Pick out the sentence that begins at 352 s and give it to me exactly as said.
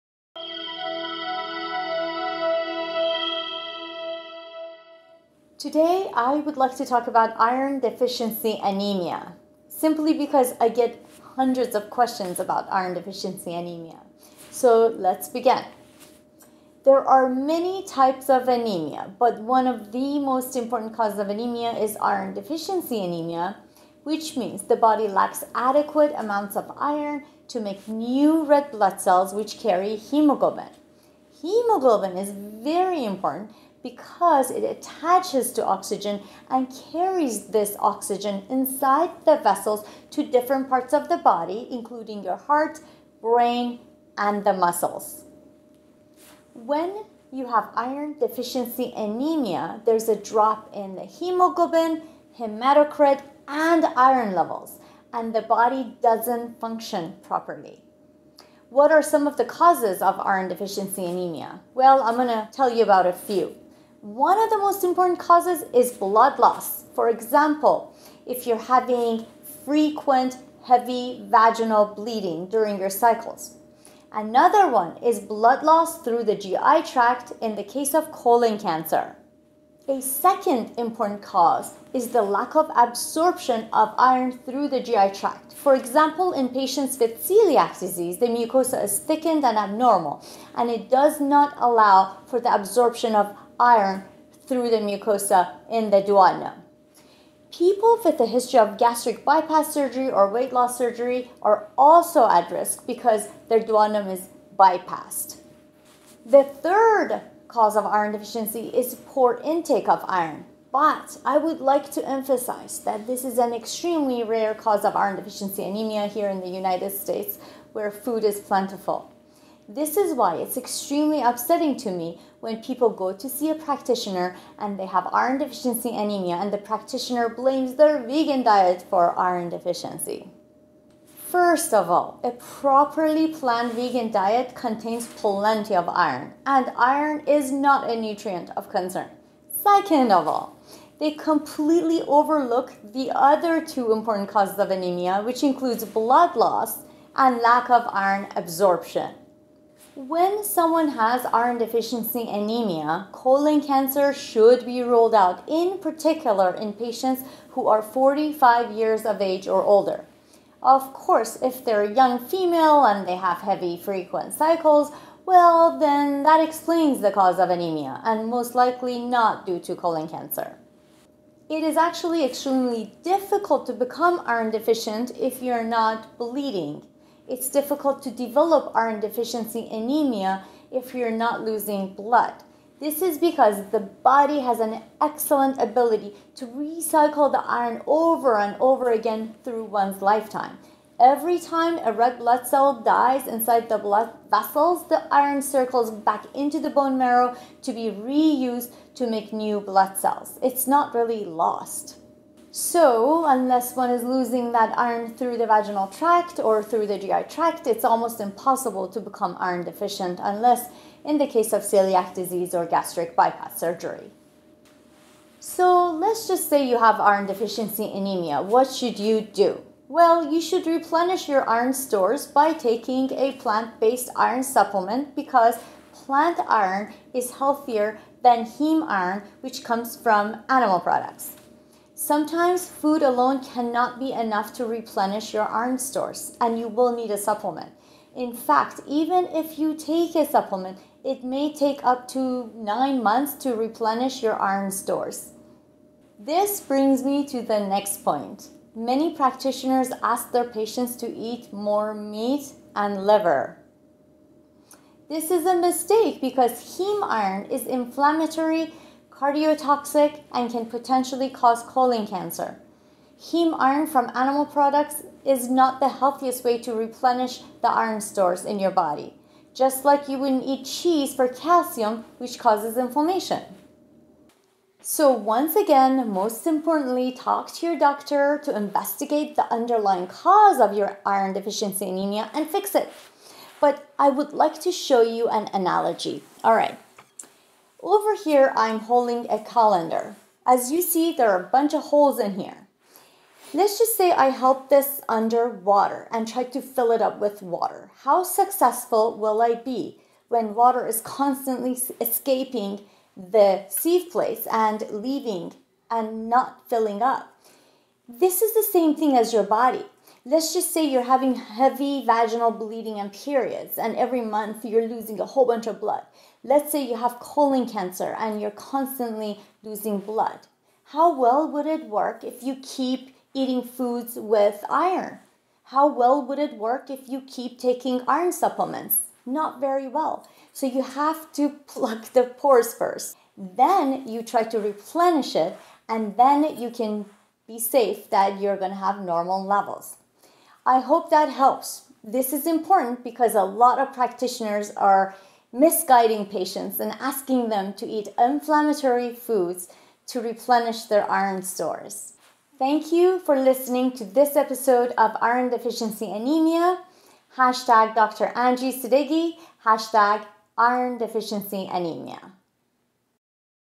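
Thank you for listening to this episode of Iron Deficiency Anemia.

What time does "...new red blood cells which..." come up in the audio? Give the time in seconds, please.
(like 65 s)
27 s.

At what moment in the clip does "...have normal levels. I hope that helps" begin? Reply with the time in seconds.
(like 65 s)
338 s.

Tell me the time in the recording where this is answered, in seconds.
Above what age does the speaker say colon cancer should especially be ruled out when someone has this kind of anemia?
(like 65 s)
157 s.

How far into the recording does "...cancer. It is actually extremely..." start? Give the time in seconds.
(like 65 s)
170 s.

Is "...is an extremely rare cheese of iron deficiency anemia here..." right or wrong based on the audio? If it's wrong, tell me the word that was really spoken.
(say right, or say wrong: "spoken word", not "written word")
wrong: "cause", not "cheese".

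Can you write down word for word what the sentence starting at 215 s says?
So, let's just say you have iron deficiency anemia.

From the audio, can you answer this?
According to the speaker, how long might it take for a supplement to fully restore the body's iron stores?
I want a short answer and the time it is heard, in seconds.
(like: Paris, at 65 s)
nine months, at 242 s.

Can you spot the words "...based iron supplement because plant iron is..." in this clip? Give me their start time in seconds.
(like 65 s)
223 s.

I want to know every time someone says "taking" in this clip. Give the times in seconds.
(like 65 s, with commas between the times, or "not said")
222 s, 327 s.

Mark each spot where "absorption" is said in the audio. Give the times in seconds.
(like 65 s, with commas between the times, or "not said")
82 s, 92 s, 148 s.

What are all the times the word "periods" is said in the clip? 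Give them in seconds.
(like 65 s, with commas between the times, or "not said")
313 s.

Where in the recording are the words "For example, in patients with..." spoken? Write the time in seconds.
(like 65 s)
85 s.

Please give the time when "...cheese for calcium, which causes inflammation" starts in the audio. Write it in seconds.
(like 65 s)
270 s.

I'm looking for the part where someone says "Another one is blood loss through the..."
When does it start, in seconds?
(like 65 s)
74 s.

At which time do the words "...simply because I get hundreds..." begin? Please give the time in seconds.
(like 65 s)
9 s.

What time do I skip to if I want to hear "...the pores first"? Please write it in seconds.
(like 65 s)
332 s.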